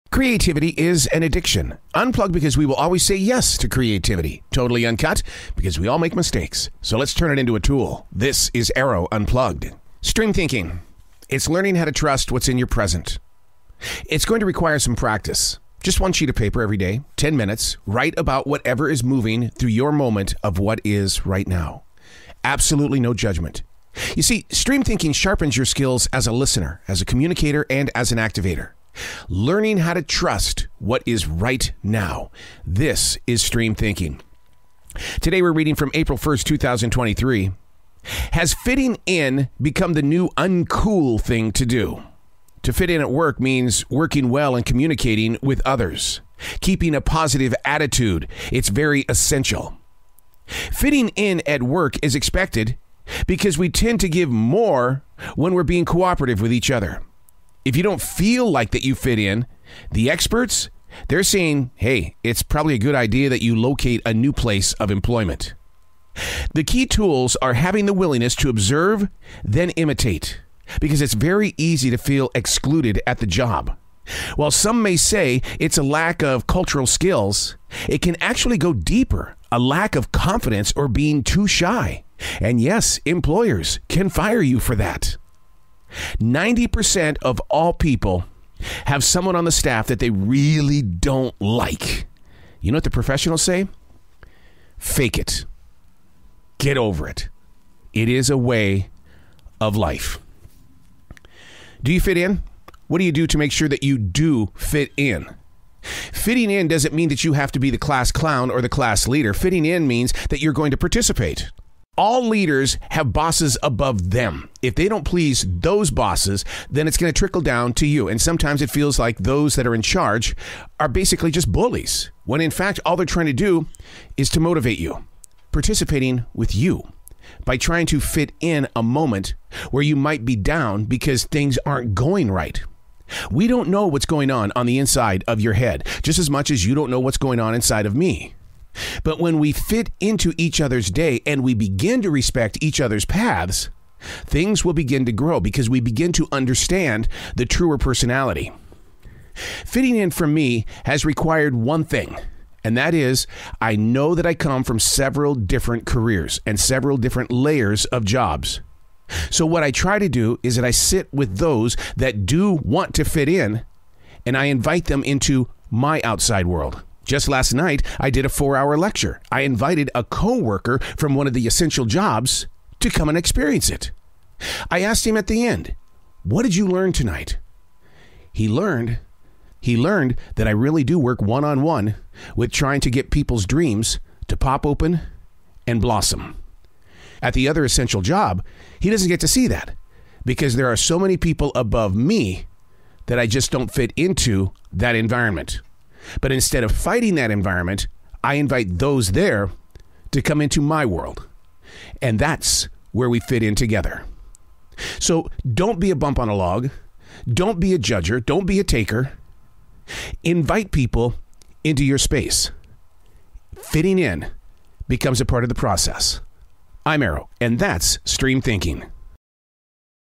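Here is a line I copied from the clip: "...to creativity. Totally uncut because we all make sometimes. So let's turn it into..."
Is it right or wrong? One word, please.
wrong.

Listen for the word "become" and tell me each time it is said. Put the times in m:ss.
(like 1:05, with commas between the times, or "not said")
0:39, 3:34.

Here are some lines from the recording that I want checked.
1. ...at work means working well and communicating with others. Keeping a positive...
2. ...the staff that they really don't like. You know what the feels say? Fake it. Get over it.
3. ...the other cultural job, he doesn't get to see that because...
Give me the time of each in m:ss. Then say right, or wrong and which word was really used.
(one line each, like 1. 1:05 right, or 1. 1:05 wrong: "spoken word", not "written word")
1. 0:43 right
2. 1:29 wrong: "professionals", not "feels"
3. 3:07 wrong: "essential", not "cultural".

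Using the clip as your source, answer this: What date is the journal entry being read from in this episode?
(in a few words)
April 1st, 2023.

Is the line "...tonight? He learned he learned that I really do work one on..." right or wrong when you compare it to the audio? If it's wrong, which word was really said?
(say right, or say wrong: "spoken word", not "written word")
right.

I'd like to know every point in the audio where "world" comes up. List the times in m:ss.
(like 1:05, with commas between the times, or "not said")
2:46, 3:20.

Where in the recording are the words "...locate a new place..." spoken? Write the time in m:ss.
1:03.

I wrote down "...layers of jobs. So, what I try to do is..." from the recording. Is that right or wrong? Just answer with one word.
right.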